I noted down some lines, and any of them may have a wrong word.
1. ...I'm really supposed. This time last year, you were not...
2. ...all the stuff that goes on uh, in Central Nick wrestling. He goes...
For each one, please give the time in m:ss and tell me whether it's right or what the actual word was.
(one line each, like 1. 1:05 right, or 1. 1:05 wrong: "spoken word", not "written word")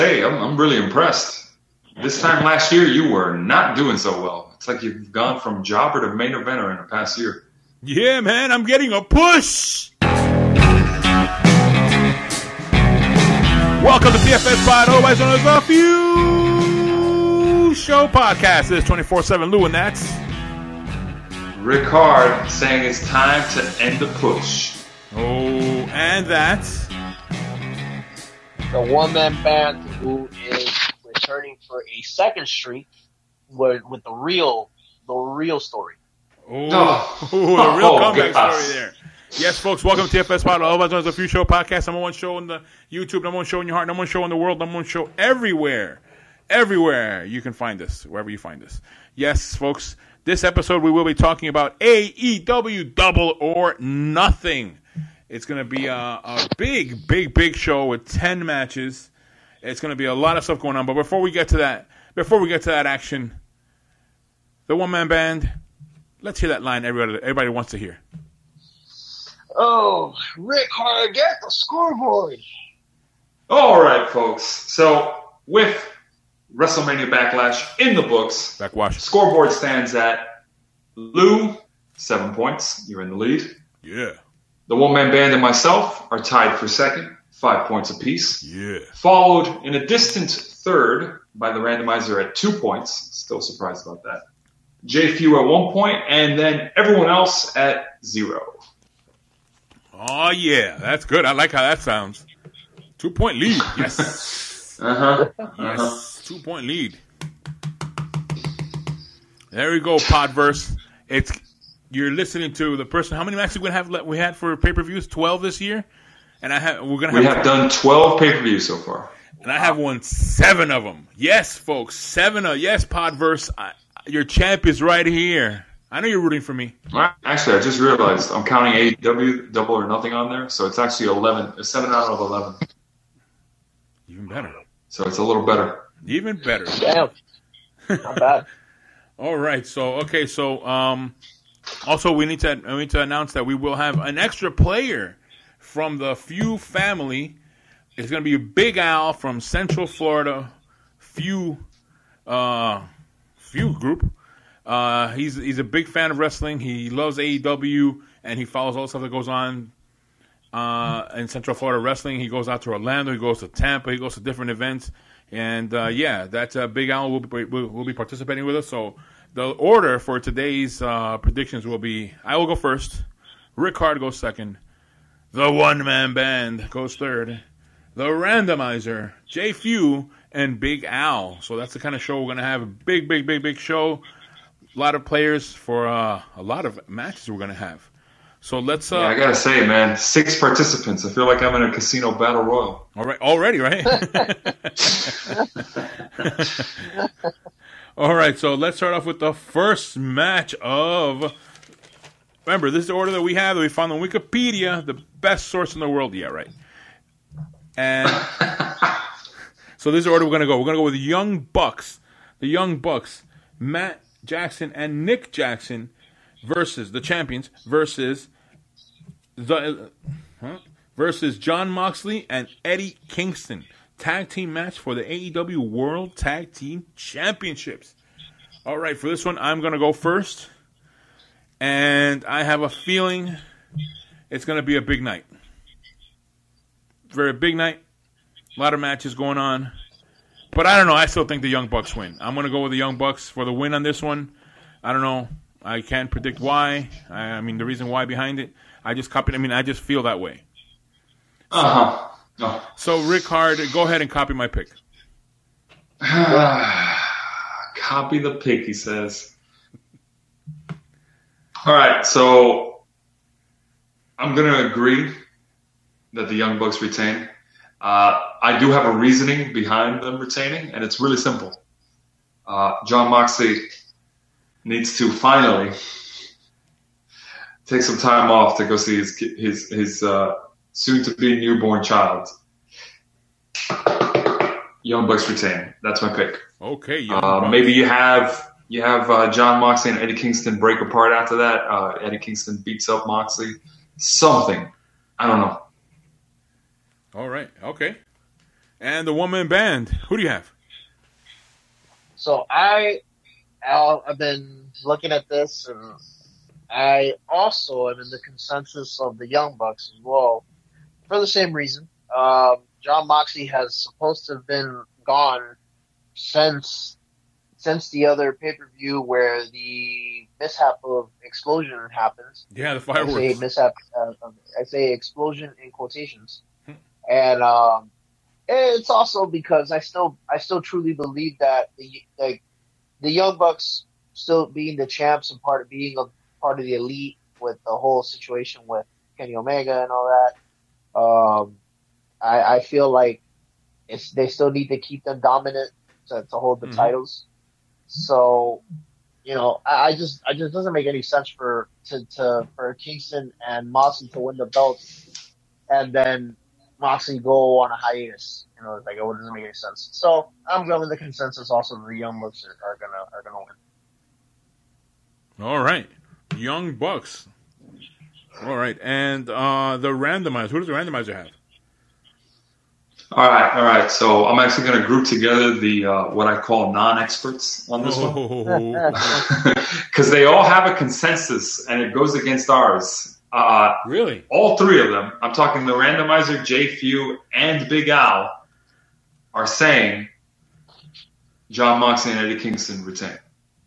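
1. 0:00 wrong: "impressed", not "supposed"
2. 2:38 wrong: "Florida", not "Nick".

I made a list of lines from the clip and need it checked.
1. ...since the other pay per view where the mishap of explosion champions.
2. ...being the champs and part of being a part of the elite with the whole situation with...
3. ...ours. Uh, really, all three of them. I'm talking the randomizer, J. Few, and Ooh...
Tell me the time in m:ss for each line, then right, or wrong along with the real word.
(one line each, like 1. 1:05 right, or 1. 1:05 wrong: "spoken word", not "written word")
1. 5:17 wrong: "happens", not "champions"
2. 5:34 right
3. 6:22 wrong: "Big", not "Ooh".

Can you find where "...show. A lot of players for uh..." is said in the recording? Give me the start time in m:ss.
3:03.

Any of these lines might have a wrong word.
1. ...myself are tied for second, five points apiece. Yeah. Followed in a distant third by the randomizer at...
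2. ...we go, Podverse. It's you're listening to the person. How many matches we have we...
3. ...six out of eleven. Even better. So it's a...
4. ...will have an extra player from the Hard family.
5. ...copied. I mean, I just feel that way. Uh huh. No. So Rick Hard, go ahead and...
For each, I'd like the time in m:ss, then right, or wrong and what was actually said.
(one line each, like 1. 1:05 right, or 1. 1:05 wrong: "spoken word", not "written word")
1. 1:25 right
2. 1:49 right
3. 2:11 wrong: "seven", not "six"
4. 2:23 wrong: "Few", not "Hard"
5. 4:09 right.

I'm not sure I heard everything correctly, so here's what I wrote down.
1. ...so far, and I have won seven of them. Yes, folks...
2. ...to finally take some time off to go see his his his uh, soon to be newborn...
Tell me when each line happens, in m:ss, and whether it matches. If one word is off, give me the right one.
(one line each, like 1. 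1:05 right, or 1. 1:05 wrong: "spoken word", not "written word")
1. 1:58 right
2. 4:34 right.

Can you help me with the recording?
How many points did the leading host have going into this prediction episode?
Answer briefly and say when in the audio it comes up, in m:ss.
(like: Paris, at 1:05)
7, at 1:21.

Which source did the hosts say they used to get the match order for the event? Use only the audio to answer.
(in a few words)
Wikipedia.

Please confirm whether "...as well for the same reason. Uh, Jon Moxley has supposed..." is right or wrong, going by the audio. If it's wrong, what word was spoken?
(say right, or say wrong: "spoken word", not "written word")
right.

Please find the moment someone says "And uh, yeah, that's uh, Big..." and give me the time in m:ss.
2:45.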